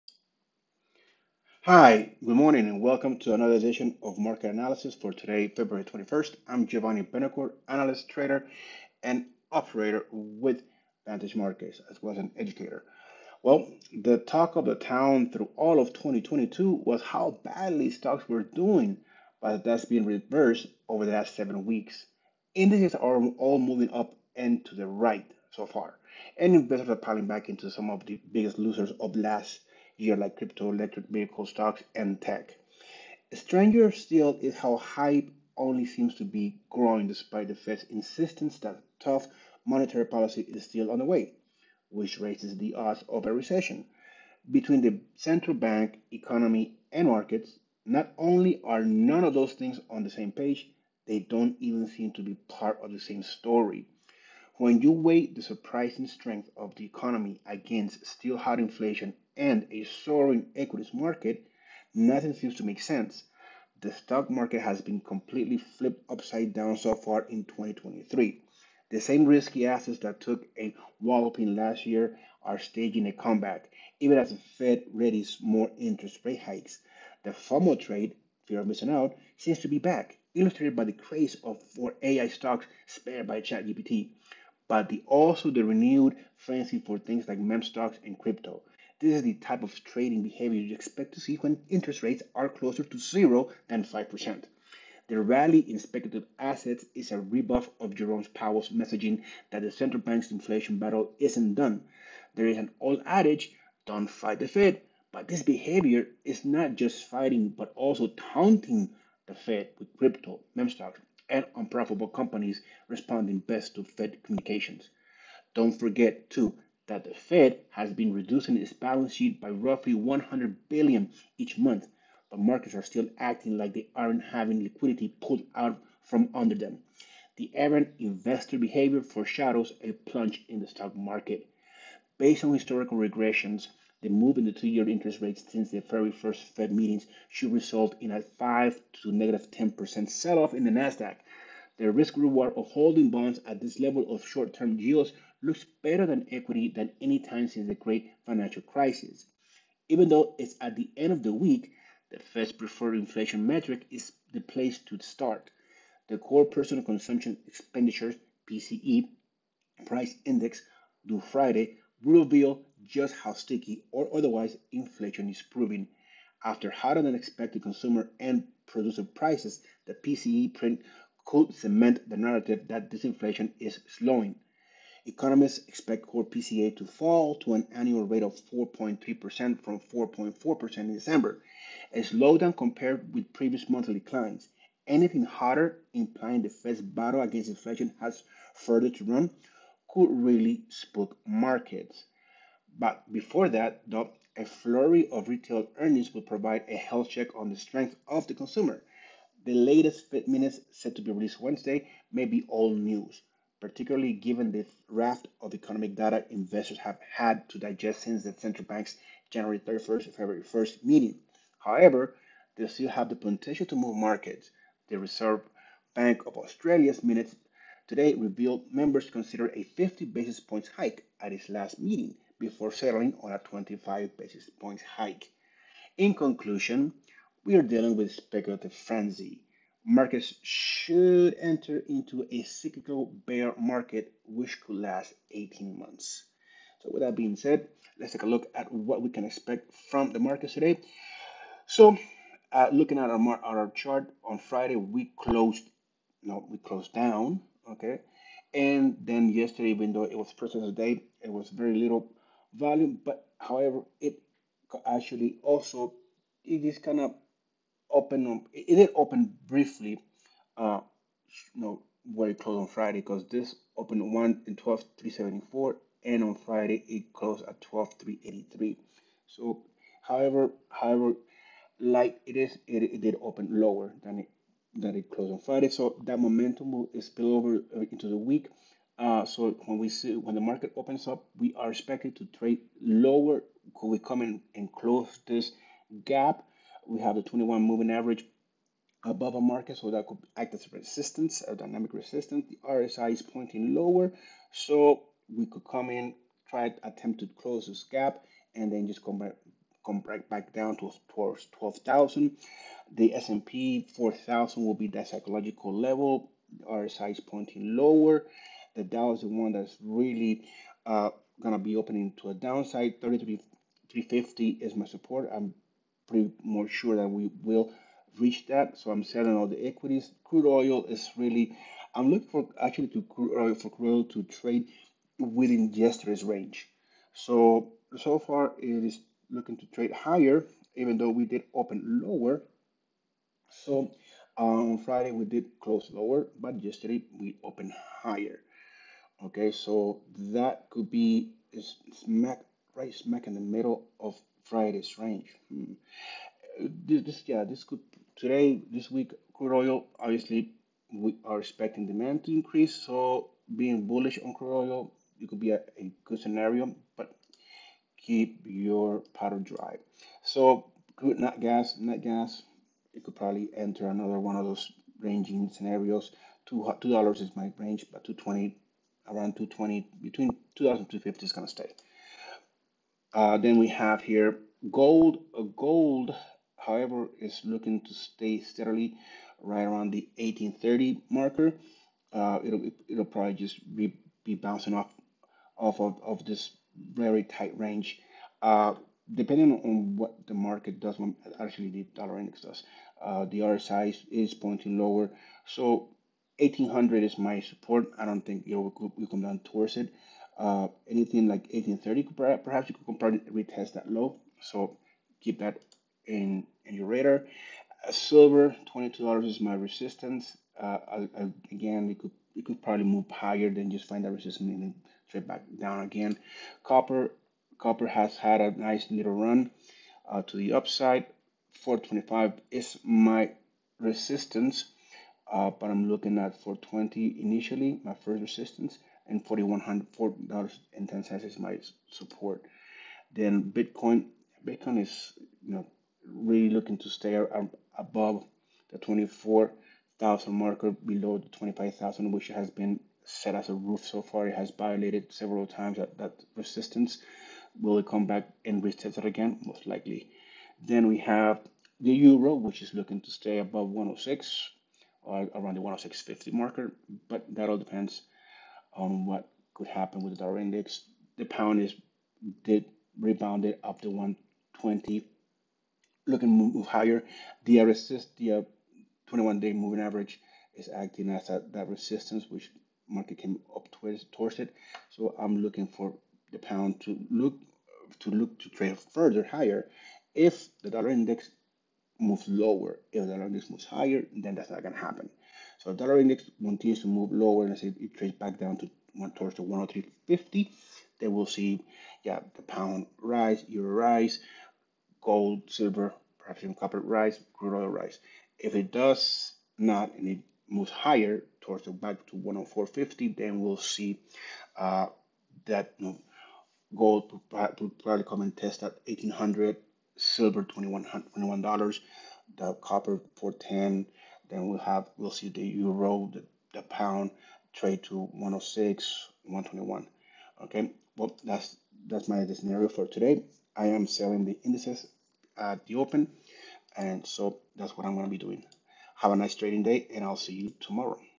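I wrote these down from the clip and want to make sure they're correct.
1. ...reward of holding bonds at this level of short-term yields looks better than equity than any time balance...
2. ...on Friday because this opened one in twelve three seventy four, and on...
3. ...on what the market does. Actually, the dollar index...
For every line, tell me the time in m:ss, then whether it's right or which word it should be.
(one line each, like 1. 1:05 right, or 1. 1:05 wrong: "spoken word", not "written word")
1. 2:22 wrong: "since", not "balance"
2. 4:22 right
3. 6:29 right.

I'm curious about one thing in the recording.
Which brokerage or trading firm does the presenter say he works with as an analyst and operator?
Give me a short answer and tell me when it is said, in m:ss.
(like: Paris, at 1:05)
Vantage Markets, at 0:11.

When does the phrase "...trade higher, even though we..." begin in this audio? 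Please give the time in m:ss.
5:29.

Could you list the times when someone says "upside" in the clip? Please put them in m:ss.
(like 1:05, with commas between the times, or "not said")
1:06, 7:00.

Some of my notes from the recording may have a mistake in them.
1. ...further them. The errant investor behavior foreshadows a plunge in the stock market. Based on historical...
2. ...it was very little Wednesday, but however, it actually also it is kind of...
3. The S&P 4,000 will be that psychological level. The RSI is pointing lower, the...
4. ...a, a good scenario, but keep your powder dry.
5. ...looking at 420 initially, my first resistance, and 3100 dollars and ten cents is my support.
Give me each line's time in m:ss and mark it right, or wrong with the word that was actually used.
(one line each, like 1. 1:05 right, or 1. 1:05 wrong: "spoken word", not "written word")
1. 2:06 wrong: "under", not "further"
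2. 4:11 wrong: "Volume", not "Wednesday"
3. 5:02 right
4. 5:55 right
5. 7:05 wrong: "4100", not "3100".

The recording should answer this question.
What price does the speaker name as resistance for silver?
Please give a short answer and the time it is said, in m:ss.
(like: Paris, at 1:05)
$22, at 6:48.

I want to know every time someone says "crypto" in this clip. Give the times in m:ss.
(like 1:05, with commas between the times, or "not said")
0:30, 1:28, 1:49.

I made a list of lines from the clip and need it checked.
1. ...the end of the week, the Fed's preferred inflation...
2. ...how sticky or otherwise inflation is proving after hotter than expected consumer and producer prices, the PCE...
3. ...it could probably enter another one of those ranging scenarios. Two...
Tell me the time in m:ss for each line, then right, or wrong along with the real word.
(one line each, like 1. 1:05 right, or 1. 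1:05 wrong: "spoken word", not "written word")
1. 2:30 right
2. 2:43 right
3. 6:02 right.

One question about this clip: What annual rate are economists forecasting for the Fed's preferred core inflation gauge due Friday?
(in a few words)
4.3%.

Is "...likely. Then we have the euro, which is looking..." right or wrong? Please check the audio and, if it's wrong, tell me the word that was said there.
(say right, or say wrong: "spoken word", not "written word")
right.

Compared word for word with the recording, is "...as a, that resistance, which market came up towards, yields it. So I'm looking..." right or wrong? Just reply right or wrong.
wrong.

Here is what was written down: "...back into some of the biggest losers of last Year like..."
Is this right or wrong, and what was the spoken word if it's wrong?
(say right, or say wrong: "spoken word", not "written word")
right.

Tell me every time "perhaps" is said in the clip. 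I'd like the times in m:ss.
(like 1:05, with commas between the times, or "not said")
6:42, 8:16.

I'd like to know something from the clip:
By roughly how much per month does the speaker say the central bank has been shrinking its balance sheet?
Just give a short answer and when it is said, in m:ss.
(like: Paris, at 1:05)
100 billion, at 1:59.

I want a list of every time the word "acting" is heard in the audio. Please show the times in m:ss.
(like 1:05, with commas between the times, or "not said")
2:03, 7:50.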